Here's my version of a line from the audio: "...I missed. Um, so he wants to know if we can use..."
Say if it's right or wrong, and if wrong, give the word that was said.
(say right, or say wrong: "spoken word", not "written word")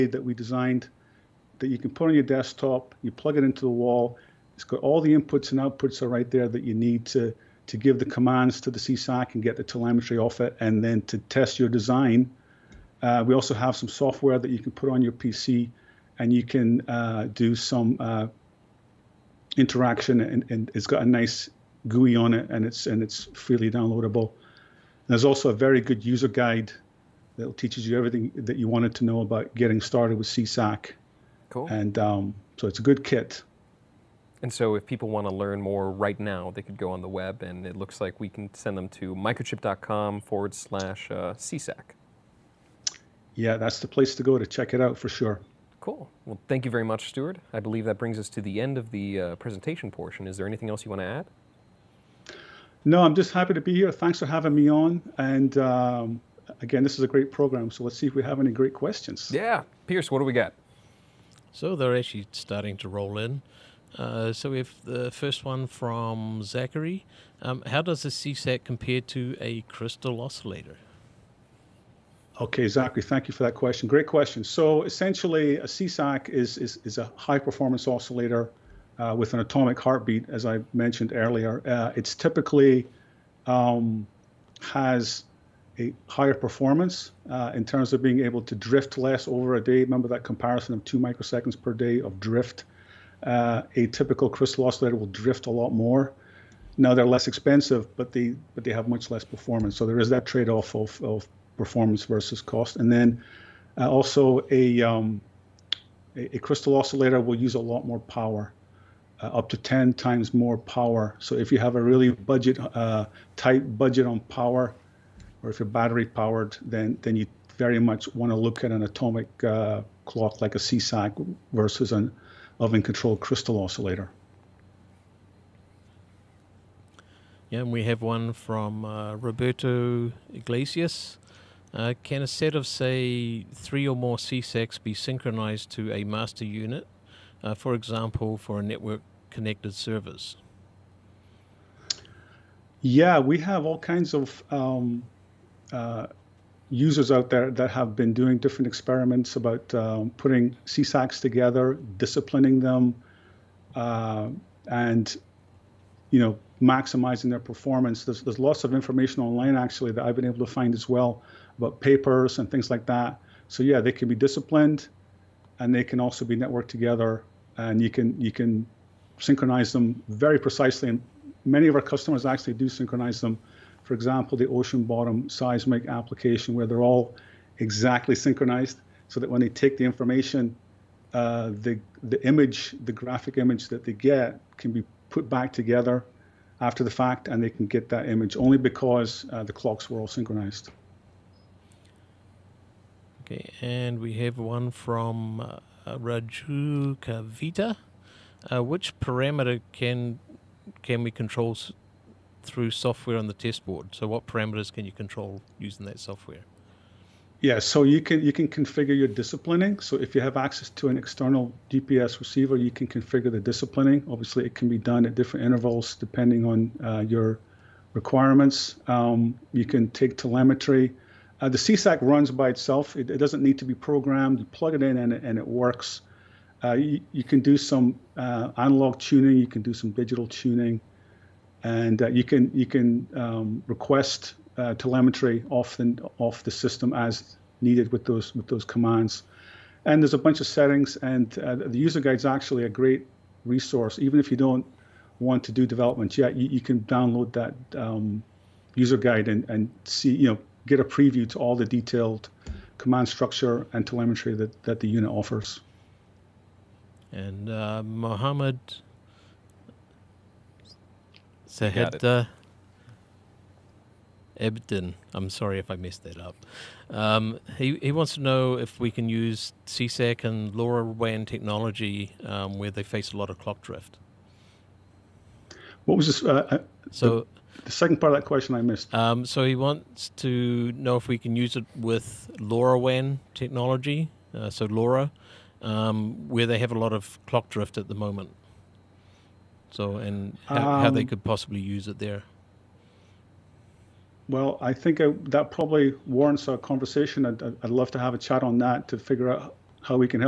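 right.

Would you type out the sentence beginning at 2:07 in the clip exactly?
Yeah, and we have one from uh, Roberto Iglesias.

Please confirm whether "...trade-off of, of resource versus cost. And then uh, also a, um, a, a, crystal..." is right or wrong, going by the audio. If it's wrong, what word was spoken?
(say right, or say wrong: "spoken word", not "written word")
wrong: "performance", not "resource".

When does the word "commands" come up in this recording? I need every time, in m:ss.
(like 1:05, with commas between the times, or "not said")
0:08, 3:58, 4:12.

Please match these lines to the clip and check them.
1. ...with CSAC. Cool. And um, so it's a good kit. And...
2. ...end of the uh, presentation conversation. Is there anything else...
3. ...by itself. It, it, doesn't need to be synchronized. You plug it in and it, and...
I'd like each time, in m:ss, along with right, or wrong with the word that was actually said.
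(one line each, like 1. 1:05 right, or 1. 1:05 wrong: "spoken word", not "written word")
1. 0:30 right
2. 0:48 wrong: "portion", not "conversation"
3. 3:42 wrong: "programmed", not "synchronized".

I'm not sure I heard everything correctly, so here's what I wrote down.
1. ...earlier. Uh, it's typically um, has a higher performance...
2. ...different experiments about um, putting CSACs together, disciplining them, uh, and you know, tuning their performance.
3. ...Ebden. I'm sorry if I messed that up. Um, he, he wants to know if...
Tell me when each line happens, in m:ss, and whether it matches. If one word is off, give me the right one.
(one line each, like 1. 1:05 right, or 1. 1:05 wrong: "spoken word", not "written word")
1. 1:21 right
2. 2:28 wrong: "maximizing", not "tuning"
3. 4:24 right.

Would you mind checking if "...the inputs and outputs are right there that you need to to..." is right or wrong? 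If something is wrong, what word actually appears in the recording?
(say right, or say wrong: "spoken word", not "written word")
right.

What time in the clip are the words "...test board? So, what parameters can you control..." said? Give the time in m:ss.
3:23.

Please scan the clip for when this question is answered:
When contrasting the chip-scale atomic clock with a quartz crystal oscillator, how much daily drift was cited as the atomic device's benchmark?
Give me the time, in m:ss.
1:30.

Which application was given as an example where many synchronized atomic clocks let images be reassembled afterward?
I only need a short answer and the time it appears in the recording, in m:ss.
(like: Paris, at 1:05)
ocean bottom seismic, at 2:54.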